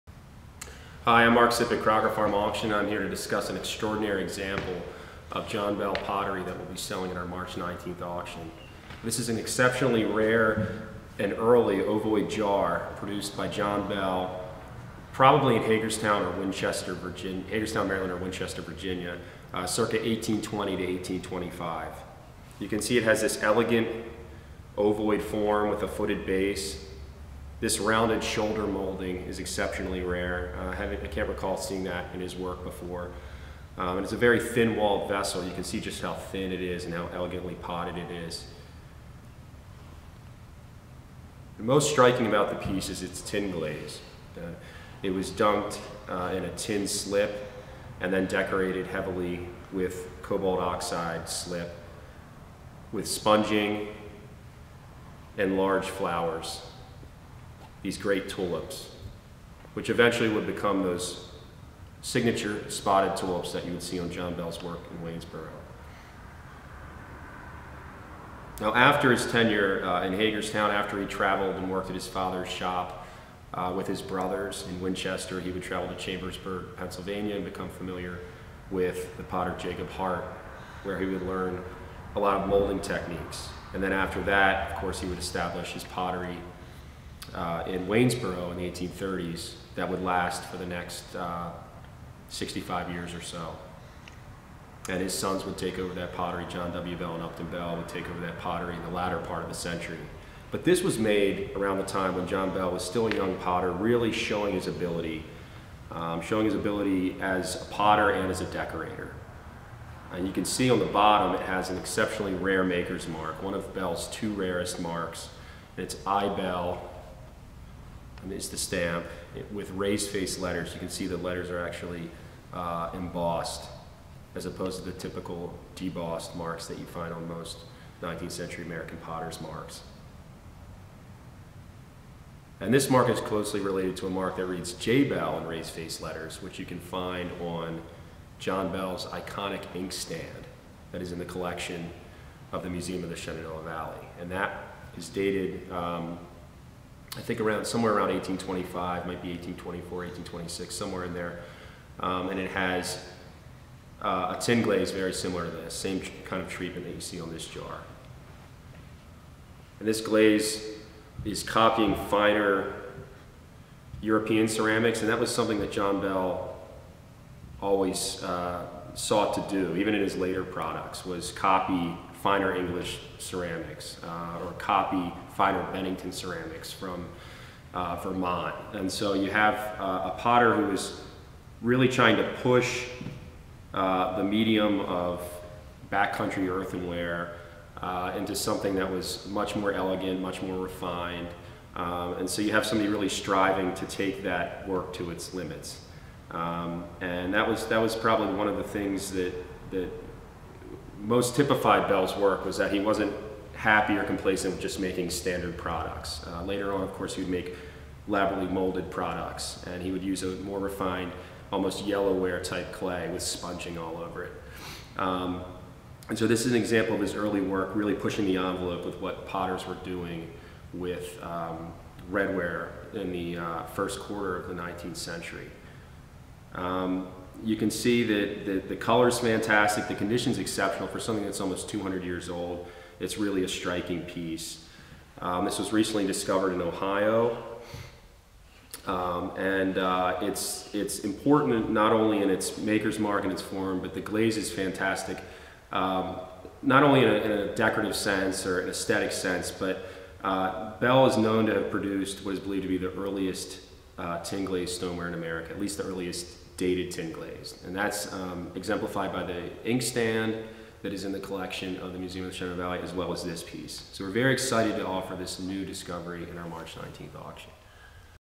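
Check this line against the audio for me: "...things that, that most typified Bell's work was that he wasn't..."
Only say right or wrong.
right.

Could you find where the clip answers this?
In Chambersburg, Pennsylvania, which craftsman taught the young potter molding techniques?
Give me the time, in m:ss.
1:19.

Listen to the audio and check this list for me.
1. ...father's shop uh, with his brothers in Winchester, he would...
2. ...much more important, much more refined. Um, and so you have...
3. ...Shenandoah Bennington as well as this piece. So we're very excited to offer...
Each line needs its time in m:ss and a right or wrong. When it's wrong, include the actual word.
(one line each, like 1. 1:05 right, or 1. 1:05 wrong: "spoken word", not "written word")
1. 1:12 right
2. 3:09 wrong: "elegant", not "important"
3. 4:22 wrong: "Valley", not "Bennington".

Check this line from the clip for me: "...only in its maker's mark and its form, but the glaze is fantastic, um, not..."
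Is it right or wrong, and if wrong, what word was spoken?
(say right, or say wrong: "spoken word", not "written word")
right.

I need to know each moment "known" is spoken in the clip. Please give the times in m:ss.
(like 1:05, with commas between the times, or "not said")
4:11.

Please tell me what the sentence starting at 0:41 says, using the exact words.
The most striking about the piece is its tin glaze.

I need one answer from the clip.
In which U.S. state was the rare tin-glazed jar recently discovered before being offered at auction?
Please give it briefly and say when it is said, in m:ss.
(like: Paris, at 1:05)
Ohio, at 3:56.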